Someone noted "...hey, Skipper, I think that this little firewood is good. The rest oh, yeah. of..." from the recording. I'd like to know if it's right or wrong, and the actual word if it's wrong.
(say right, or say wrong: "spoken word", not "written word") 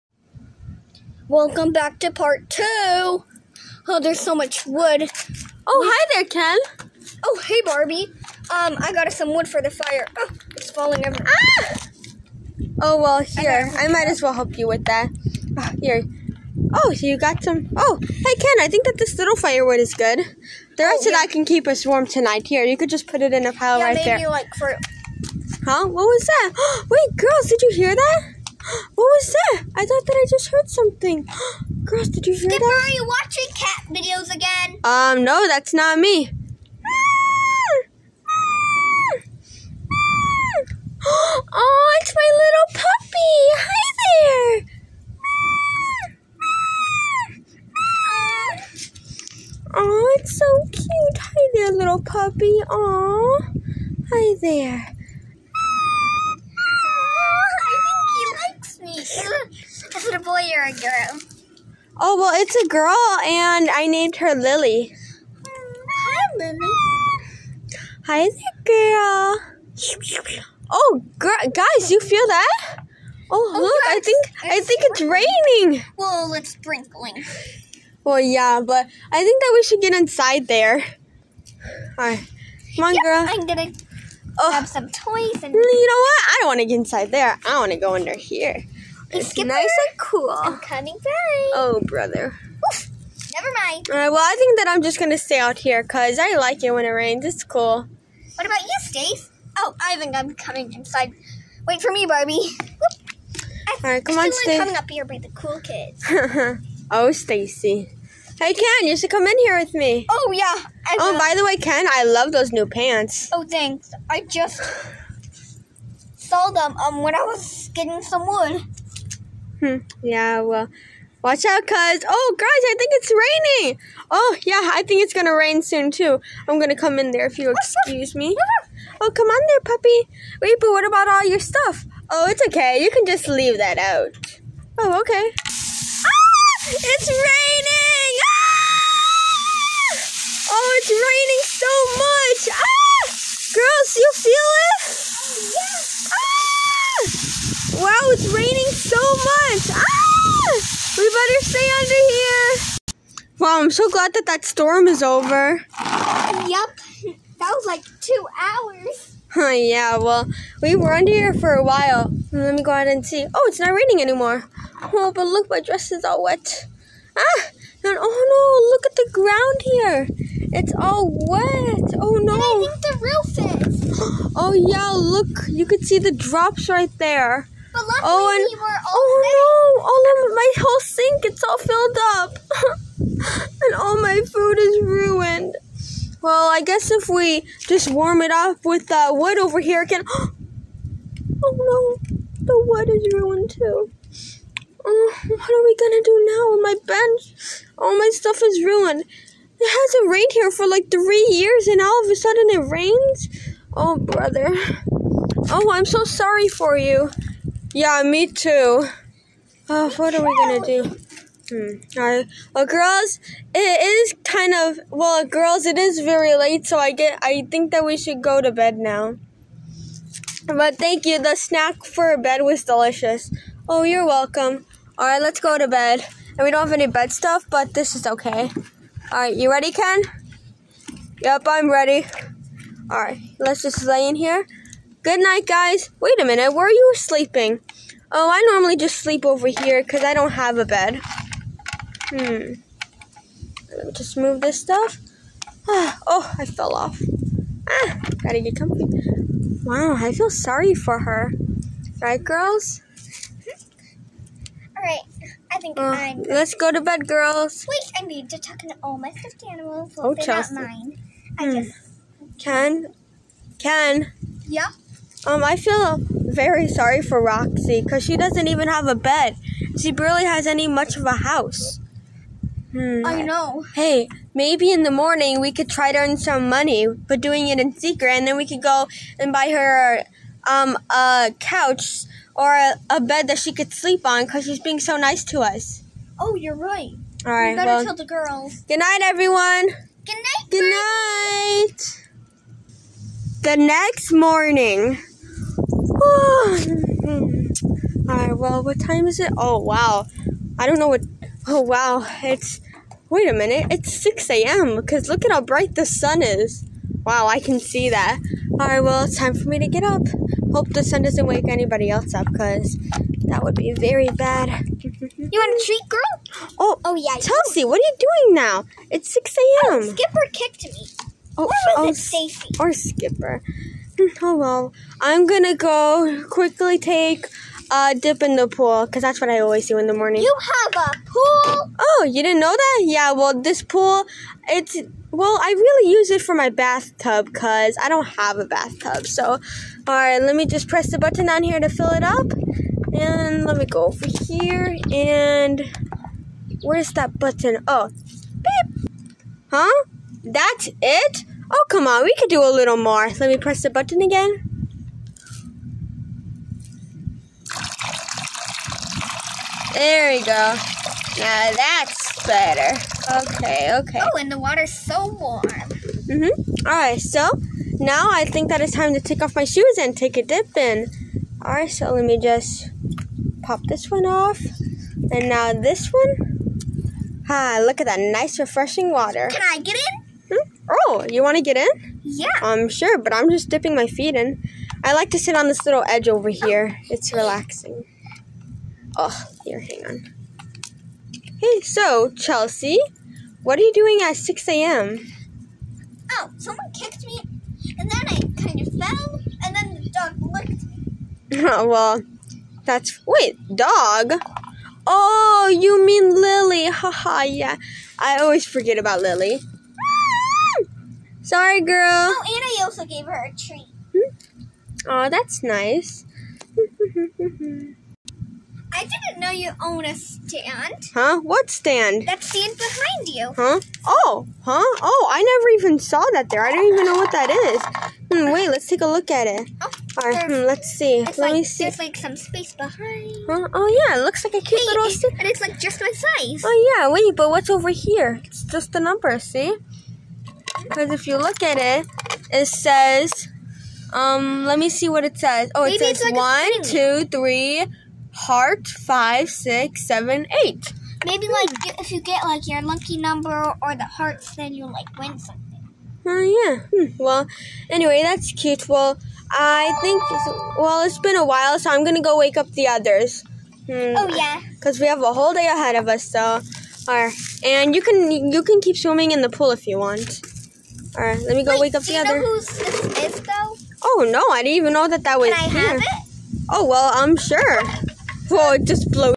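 wrong: "Ken", not "Skipper".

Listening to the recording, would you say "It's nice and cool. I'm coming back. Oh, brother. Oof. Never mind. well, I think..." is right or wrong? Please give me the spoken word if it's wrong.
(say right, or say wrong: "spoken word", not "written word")
right.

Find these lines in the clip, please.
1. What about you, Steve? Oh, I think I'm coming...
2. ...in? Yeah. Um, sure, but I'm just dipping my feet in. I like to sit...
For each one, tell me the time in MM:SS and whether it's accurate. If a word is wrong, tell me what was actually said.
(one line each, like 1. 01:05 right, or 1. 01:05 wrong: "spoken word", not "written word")
1. 01:38 right
2. 06:21 right.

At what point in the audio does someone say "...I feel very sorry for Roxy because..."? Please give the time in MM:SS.
04:25.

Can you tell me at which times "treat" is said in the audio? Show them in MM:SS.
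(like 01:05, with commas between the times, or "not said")
05:15, 06:53.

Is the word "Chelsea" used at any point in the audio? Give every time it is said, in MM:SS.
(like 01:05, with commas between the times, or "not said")
04:20, 05:17, 06:32.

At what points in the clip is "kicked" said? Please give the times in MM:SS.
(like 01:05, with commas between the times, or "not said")
05:20, 06:36.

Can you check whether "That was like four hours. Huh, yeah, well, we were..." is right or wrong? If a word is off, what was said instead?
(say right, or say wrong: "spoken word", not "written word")
wrong: "two", not "four".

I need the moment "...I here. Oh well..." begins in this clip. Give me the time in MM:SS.
07:55.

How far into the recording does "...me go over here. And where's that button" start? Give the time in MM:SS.
05:43.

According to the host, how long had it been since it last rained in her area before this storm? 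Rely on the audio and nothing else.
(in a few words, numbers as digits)
three years.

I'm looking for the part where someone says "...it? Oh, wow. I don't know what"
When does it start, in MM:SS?
04:59.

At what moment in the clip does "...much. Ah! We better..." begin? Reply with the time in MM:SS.
02:29.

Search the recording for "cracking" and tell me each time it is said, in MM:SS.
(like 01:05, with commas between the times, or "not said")
not said.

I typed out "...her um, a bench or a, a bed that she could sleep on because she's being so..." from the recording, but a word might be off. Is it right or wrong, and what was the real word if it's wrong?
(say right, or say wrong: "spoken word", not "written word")
wrong: "couch", not "bench".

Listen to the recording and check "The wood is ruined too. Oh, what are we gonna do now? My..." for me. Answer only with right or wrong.
right.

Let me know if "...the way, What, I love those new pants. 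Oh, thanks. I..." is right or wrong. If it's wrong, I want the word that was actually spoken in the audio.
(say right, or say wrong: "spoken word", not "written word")
wrong: "Ken", not "What".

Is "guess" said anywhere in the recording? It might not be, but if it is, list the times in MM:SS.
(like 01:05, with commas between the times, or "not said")
03:06.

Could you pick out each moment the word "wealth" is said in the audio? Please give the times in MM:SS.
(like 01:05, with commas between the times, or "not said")
not said.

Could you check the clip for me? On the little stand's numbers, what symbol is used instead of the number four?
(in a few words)
heart.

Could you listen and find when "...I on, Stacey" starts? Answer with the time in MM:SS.
01:44.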